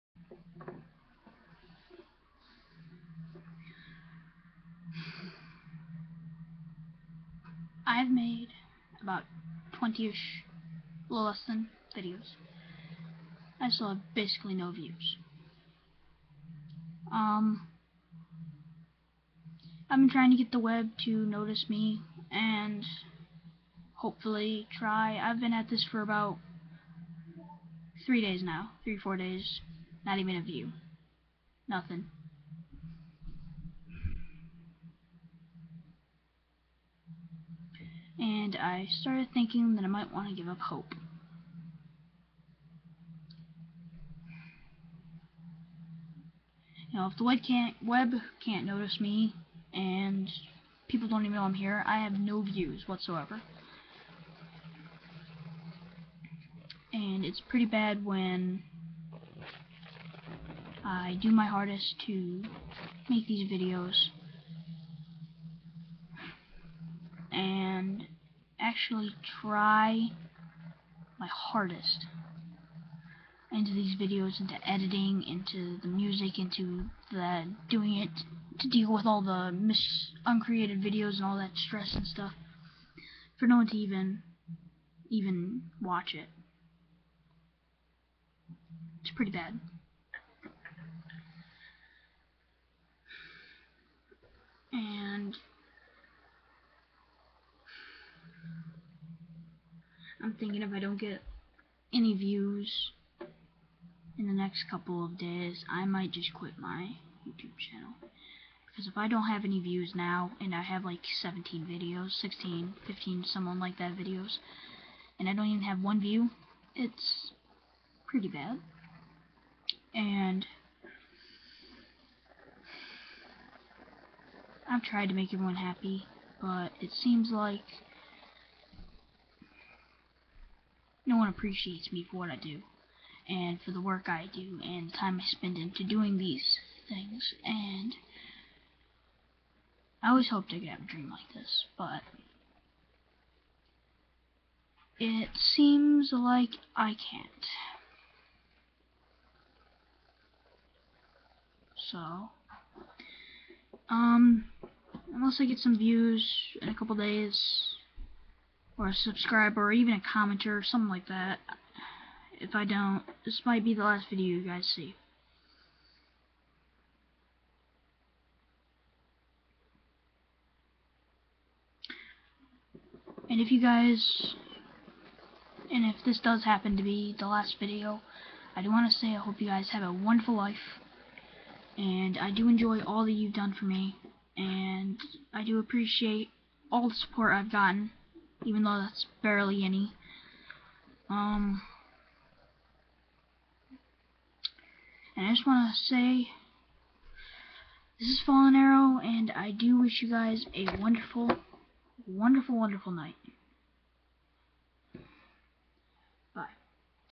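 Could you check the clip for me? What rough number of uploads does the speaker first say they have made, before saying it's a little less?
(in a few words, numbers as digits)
20-ish.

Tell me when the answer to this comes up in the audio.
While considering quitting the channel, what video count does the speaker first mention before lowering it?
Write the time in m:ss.
1:51.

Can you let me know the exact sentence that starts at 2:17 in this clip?
And I always hoped I could have a dream like this, but it seems like I can't.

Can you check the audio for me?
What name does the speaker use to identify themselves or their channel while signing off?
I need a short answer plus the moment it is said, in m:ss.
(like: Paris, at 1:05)
Fallen Arrow, at 3:18.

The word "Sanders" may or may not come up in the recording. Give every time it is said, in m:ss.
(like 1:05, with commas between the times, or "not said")
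not said.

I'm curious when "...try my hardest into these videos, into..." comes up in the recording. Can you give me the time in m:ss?
1:09.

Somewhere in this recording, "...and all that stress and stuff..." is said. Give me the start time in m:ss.
1:21.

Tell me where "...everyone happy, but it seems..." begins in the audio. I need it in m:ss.
2:05.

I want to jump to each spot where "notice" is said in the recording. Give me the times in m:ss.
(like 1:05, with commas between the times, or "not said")
0:21, 0:48.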